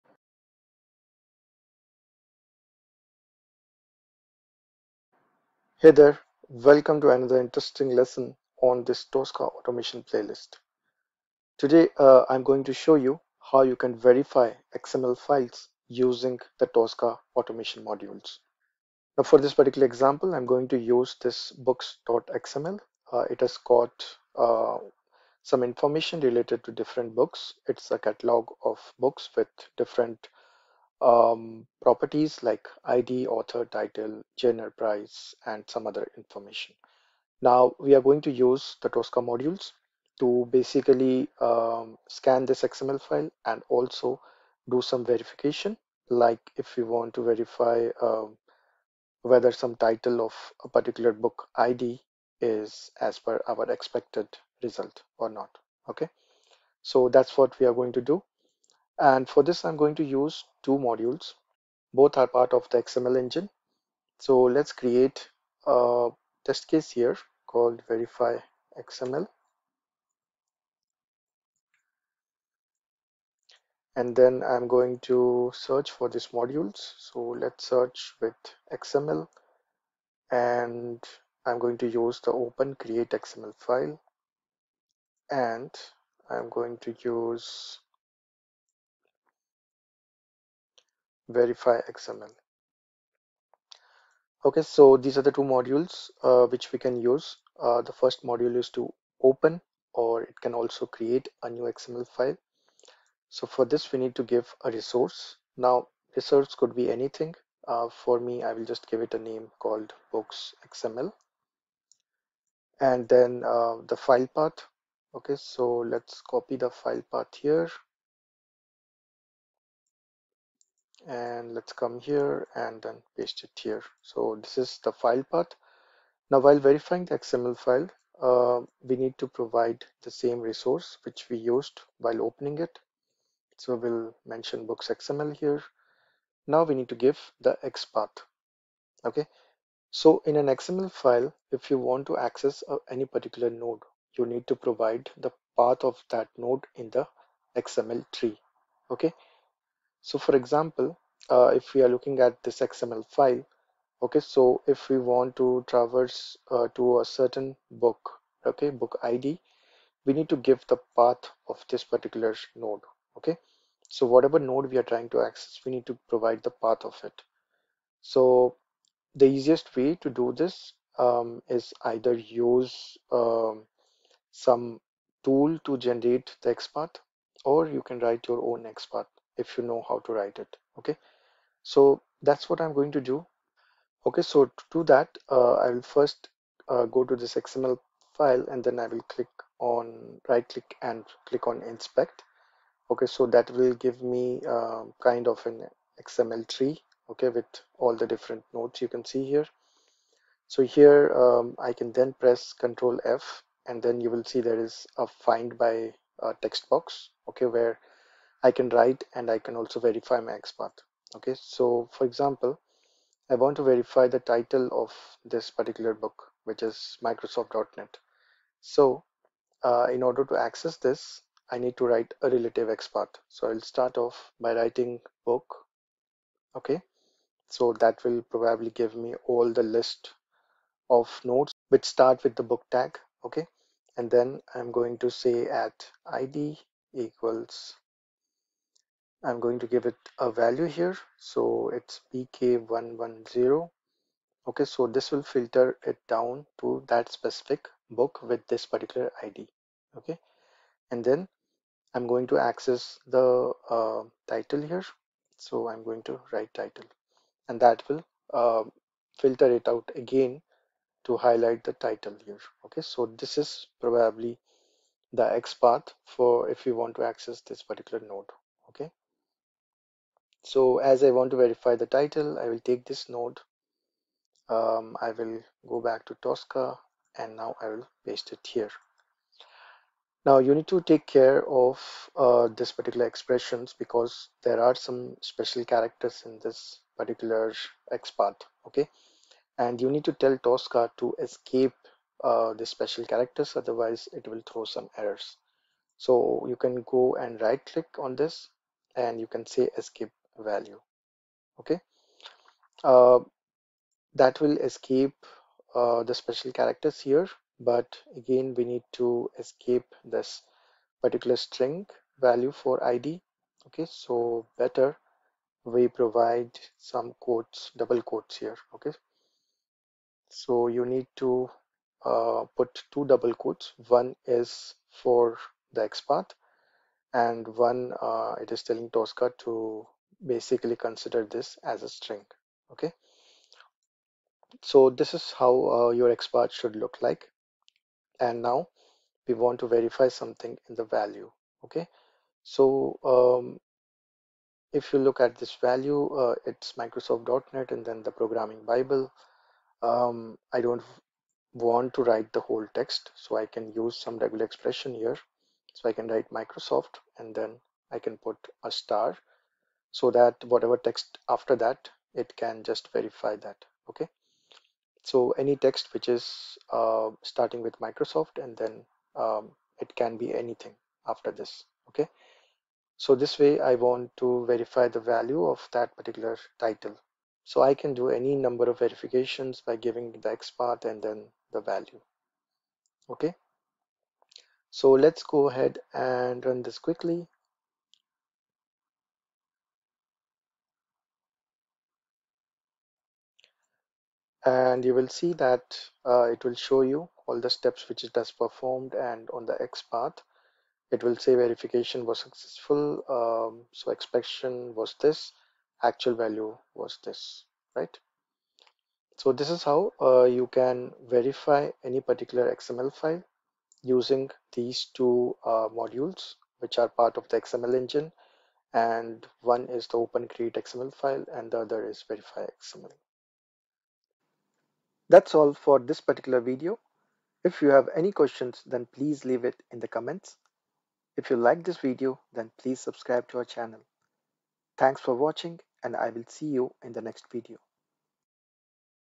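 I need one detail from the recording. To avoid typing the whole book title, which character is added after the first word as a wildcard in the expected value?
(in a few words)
star.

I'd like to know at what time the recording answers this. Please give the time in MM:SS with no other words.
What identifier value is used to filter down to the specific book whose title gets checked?
04:02.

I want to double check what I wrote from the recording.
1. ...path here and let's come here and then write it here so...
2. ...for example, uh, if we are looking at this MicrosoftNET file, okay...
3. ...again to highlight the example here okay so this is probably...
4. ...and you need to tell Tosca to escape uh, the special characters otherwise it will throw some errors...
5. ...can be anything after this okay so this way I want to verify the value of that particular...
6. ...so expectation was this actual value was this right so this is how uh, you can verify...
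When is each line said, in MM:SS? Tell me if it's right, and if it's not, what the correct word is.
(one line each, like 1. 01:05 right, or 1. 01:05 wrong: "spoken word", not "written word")
1. 01:57 wrong: "paste", not "write"
2. 02:30 wrong: "XML", not "MicrosoftNET"
3. 04:19 wrong: "title", not "example"
4. 04:49 right
5. 06:09 right
6. 06:43 right.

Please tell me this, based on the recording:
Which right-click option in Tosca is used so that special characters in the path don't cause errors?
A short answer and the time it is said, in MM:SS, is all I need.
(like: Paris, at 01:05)
Escape value, at 04:59.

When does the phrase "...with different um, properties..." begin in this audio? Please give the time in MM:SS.
00:29.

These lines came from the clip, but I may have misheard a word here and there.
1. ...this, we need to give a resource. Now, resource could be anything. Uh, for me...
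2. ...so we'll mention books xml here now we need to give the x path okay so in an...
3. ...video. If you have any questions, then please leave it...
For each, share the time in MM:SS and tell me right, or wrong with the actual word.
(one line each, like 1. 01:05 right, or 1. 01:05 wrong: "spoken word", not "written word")
1. 01:43 right
2. 02:13 right
3. 07:06 right.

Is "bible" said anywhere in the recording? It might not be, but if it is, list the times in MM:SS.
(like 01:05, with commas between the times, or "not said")
05:48.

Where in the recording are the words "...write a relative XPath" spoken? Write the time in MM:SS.
03:41.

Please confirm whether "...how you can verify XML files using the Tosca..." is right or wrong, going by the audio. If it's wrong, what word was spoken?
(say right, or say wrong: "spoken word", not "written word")
right.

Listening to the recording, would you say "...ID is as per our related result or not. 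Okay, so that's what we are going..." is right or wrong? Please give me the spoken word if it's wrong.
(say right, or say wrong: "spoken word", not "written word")
wrong: "expected", not "related".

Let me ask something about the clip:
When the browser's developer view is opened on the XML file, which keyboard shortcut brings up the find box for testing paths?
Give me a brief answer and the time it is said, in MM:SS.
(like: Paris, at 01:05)
Control F, at 03:22.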